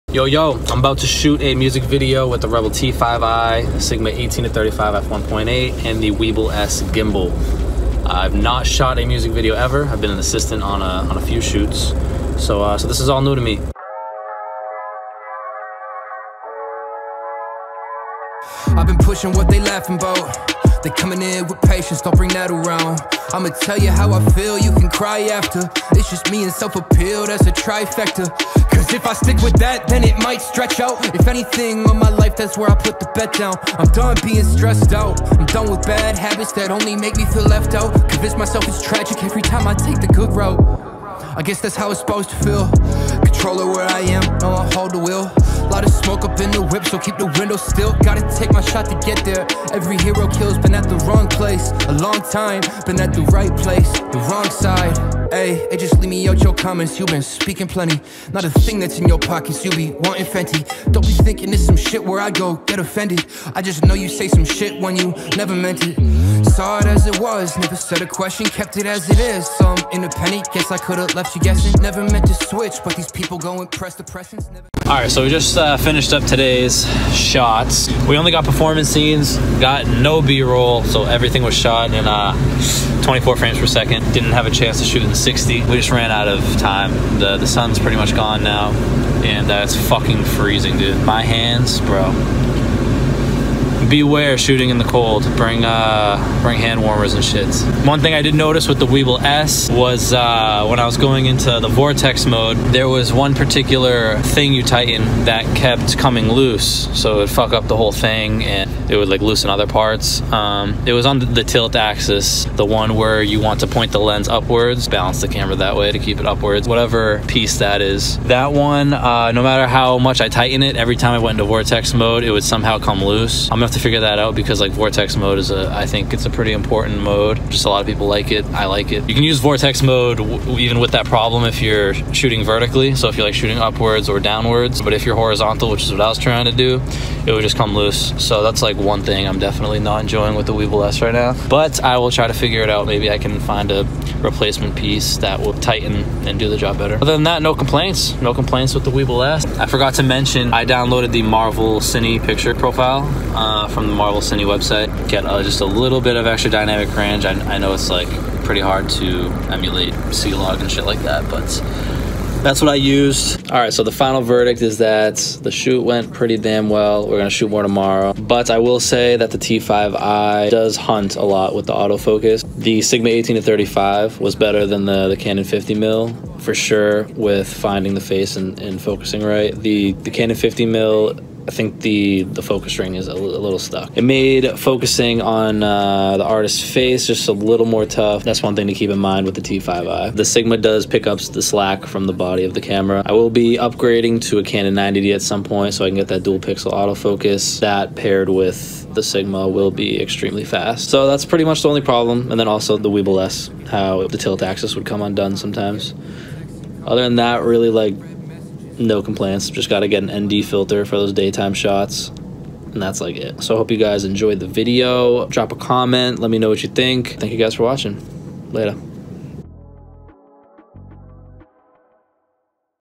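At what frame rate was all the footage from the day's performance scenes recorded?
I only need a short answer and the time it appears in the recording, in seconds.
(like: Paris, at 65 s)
24 frames per second, at 83 s.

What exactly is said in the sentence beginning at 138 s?
So that's like one thing I'm definitely not enjoying with the Weebill S right now.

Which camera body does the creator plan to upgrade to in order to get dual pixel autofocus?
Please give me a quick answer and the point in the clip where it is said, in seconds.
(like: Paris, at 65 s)
Canon 90D, at 194 s.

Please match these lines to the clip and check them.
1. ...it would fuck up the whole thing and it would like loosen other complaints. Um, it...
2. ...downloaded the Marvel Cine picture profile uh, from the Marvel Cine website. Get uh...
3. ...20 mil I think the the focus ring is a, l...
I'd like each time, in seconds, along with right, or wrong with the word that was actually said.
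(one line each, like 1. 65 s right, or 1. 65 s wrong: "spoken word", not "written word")
1. 107 s wrong: "parts", not "complaints"
2. 150 s right
3. 180 s wrong: "50", not "20".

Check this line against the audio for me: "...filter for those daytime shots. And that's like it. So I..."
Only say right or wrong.
right.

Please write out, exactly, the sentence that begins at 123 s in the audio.
I'm gonna have to figure that out because like vortex mode is a, I think it's a pretty important mode.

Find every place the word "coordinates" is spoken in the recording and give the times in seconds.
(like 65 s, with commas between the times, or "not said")
not said.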